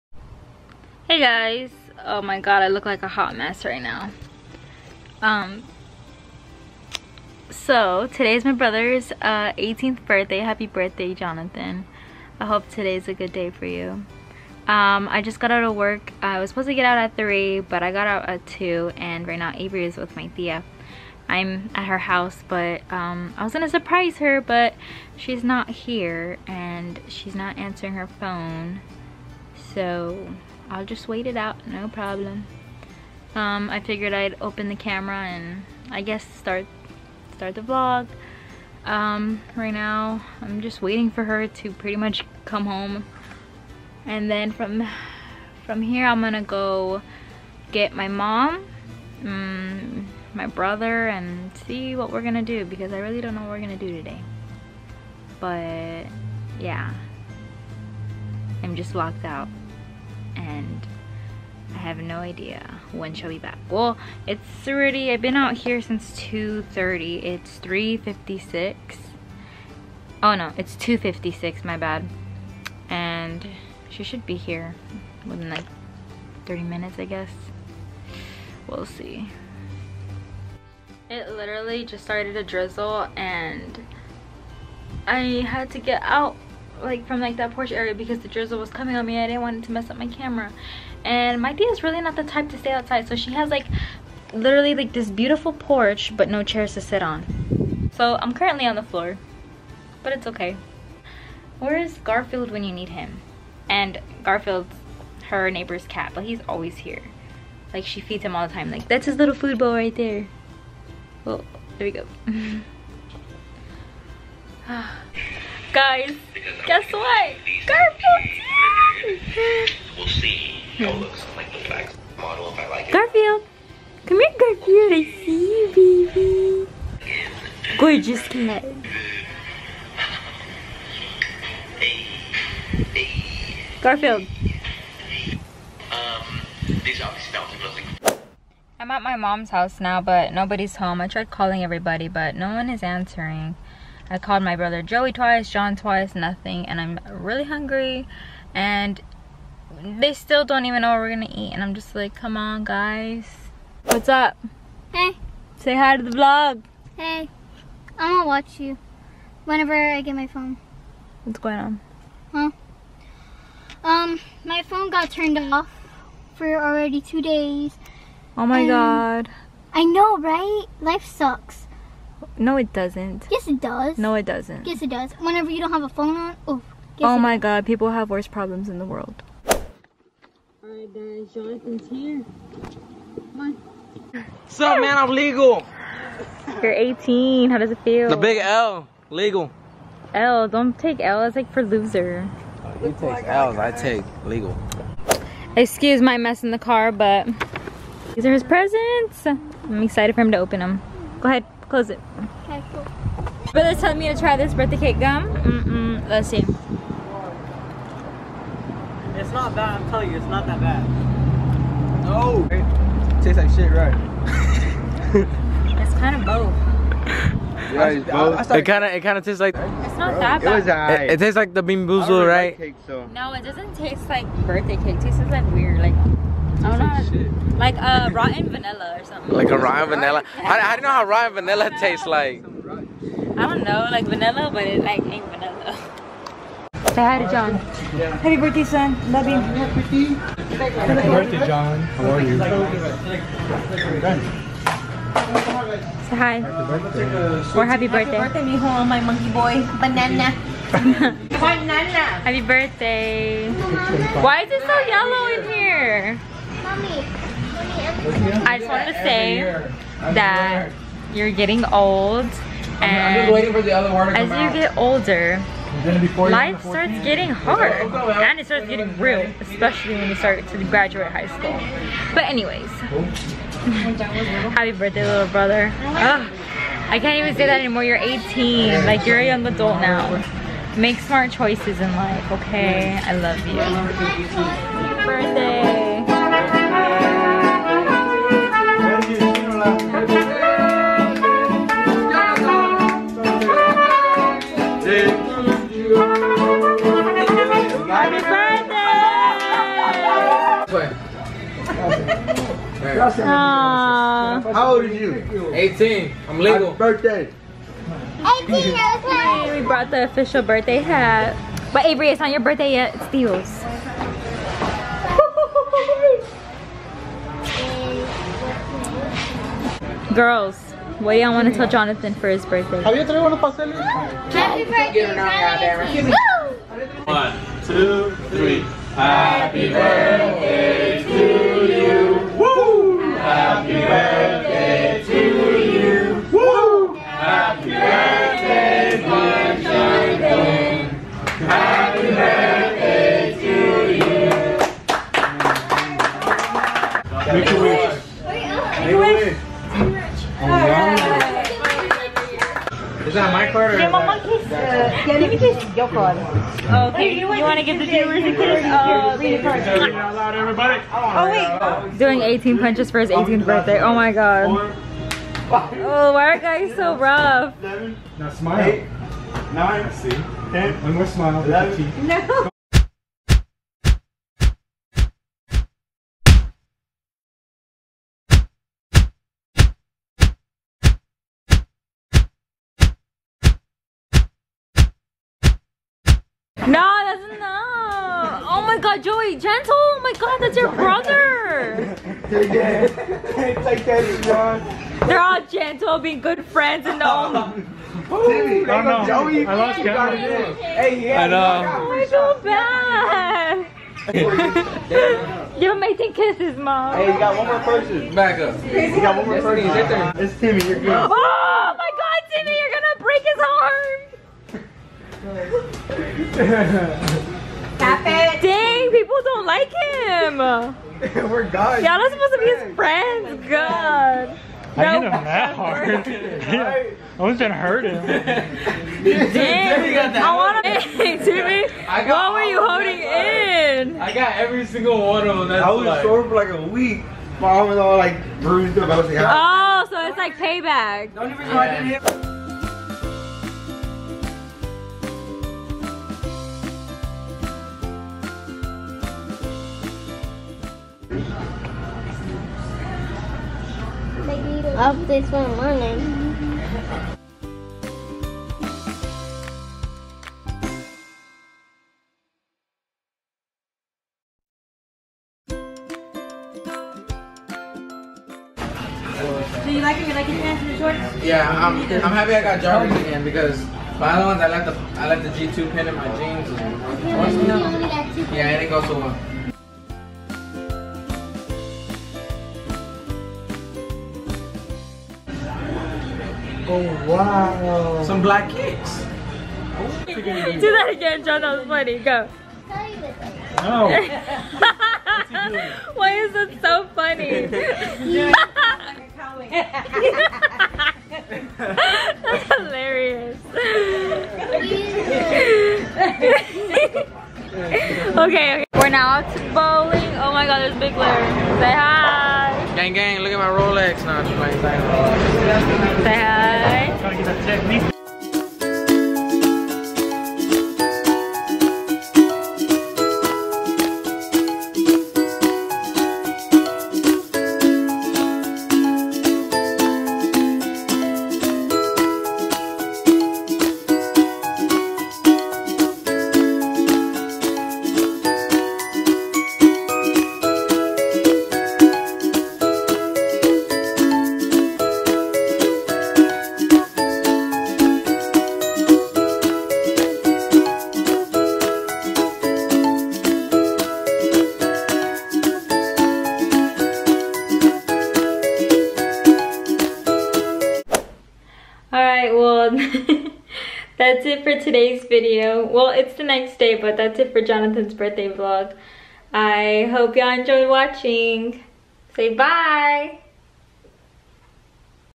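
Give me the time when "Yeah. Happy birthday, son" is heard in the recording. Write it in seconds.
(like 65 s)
237 s.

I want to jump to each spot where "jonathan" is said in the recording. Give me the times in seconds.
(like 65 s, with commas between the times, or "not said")
11 s, 181 s, 321 s, 567 s.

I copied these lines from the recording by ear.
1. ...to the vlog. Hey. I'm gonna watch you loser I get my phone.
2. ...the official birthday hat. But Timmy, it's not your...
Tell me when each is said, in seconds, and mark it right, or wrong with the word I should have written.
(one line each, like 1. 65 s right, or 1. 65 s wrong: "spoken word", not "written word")
1. 155 s wrong: "whenever", not "loser"
2. 309 s wrong: "Avery", not "Timmy".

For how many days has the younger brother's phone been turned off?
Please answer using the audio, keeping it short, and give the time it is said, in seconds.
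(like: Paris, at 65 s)
2 days, at 166 s.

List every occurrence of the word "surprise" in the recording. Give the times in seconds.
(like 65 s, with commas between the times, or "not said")
23 s.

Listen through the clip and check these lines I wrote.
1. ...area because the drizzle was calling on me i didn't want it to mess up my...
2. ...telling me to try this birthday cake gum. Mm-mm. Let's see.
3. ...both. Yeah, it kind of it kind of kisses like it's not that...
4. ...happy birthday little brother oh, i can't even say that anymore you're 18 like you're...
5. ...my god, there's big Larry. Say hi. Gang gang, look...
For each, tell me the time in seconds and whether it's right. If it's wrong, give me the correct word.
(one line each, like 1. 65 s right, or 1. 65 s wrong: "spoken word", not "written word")
1. 87 s wrong: "coming", not "calling"
2. 203 s right
3. 216 s wrong: "tastes", not "kisses"
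4. 274 s right
5. 510 s right.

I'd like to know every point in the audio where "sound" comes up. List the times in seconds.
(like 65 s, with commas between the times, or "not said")
not said.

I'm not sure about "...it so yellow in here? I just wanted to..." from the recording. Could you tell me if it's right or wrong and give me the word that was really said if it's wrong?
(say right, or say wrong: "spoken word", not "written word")
right.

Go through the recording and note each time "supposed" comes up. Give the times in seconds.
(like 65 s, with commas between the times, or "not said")
16 s, 422 s.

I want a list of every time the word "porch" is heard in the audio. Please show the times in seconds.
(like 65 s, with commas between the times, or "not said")
87 s, 95 s.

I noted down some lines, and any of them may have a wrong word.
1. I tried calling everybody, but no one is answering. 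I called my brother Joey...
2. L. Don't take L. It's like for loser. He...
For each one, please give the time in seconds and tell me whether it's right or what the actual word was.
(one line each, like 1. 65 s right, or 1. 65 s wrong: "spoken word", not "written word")
1. 140 s right
2. 190 s right.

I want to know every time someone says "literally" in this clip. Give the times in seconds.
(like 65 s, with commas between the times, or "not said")
81 s, 94 s.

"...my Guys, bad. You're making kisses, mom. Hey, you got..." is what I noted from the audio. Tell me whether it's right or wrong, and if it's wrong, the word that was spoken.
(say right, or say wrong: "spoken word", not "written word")
wrong: "God", not "Guys".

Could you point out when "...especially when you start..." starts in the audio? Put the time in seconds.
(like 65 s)
269 s.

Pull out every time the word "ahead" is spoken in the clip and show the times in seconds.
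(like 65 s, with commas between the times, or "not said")
201 s.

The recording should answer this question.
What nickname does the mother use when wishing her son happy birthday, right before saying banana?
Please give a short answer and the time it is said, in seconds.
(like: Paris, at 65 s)
monkey boy, at 248 s.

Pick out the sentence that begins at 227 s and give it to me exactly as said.
Like uh, rotten vanilla or something.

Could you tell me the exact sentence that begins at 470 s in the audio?
You like your pants and your shorts?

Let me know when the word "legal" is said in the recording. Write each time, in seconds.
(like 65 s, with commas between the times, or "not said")
185 s, 189 s, 194 s, 306 s.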